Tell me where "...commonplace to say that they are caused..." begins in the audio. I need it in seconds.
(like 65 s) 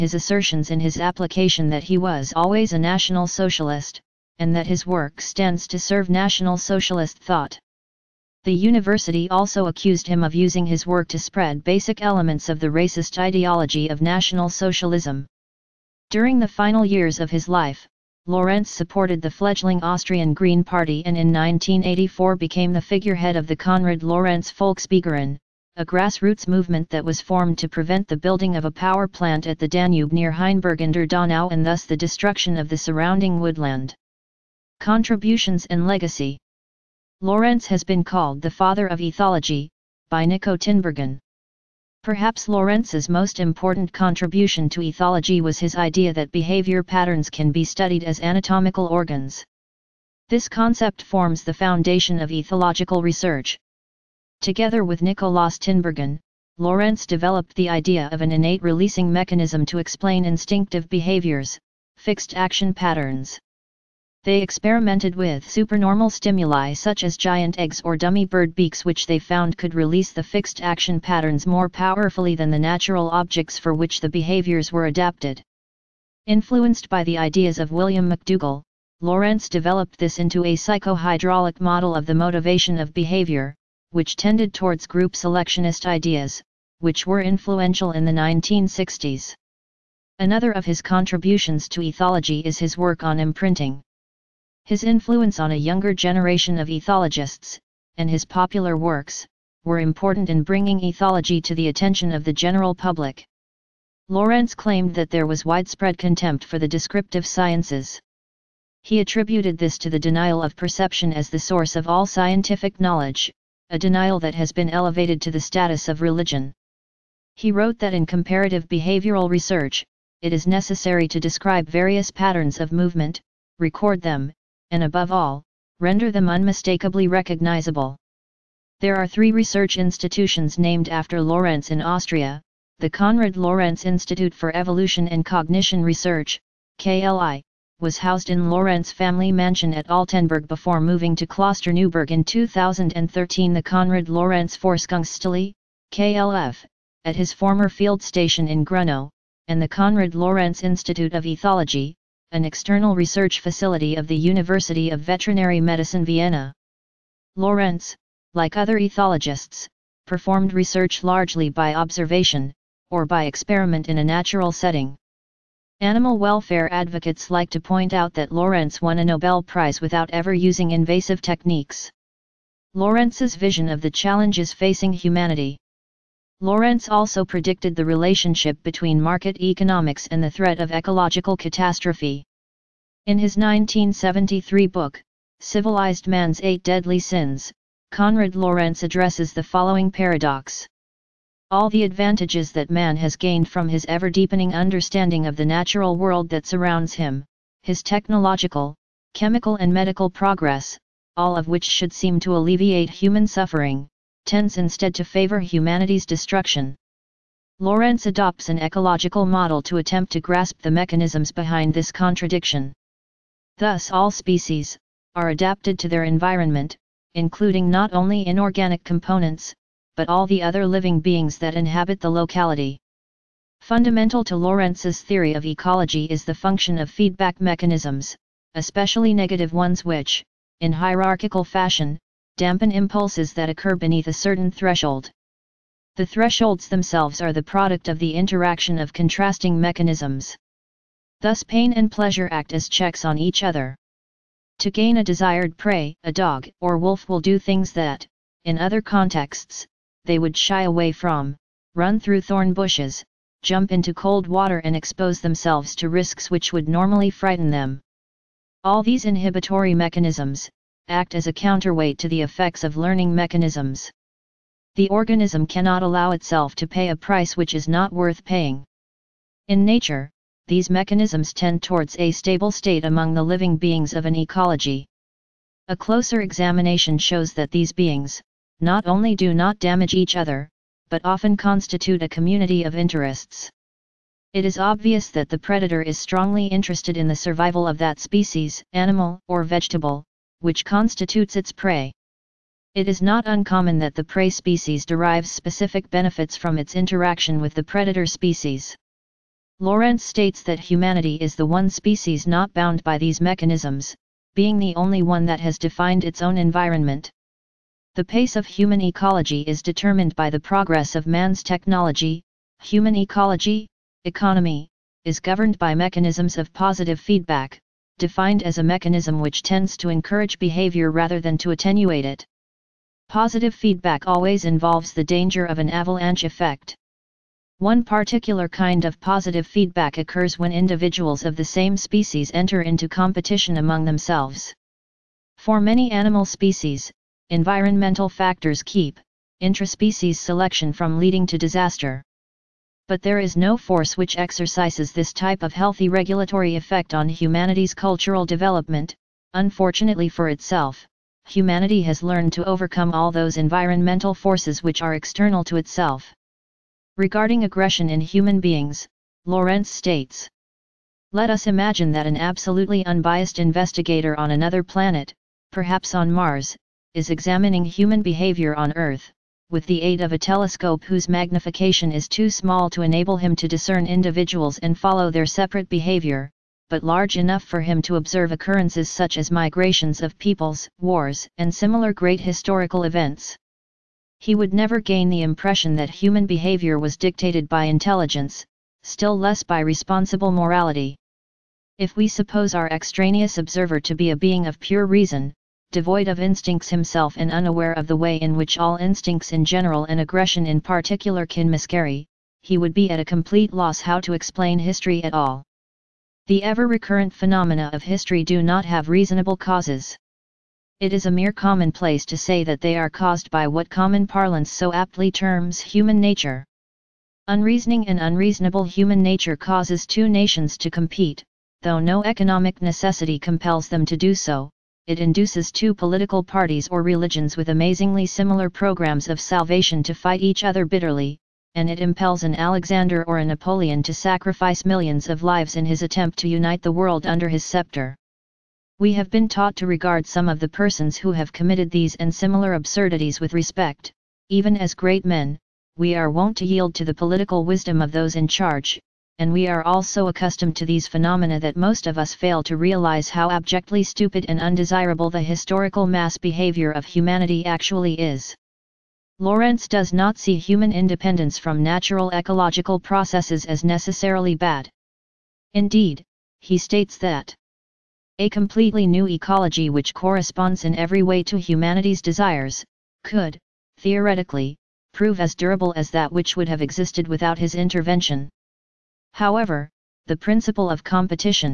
411 s.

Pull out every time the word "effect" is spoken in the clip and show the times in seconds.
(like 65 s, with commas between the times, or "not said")
262 s, 326 s, 346 s.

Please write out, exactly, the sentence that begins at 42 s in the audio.
Perhaps Lorenz's most important contribution to ethology was his idea that behavior patterns can be studied as anatomical organs.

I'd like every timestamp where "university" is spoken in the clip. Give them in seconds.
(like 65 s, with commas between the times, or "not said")
8 s, 154 s.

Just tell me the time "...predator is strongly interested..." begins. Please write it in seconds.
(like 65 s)
285 s.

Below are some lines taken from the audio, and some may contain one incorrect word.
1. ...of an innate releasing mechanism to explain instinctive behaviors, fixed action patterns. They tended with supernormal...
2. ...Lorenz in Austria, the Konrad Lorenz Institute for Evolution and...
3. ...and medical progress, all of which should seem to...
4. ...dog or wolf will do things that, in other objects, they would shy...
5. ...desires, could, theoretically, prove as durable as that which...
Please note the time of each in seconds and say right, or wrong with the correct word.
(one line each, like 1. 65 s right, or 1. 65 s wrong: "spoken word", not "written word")
1. 58 s wrong: "experimented", not "tended"
2. 131 s right
3. 199 s right
4. 246 s wrong: "contexts", not "objects"
5. 472 s right.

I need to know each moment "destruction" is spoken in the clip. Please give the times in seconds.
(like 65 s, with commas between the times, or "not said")
31 s, 206 s.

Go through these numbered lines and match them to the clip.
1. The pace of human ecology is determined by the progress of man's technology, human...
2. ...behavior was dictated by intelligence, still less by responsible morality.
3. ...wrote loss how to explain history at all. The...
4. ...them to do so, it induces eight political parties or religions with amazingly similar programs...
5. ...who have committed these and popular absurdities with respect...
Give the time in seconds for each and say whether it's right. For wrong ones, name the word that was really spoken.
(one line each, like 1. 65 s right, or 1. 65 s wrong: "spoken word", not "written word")
1. 307 s right
2. 386 s right
3. 403 s wrong: "complete", not "wrote"
4. 423 s wrong: "two", not "eight"
5. 440 s wrong: "similar", not "popular".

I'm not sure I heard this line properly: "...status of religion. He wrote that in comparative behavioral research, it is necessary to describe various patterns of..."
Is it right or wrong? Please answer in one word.
right.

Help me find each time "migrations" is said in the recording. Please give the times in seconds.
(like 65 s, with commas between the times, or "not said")
379 s.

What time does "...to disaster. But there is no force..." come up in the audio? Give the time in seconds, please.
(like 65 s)
341 s.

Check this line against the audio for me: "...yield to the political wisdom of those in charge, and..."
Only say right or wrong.
right.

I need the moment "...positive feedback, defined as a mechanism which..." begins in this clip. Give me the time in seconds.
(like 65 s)
316 s.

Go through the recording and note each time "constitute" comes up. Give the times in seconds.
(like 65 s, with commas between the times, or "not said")
281 s, 290 s.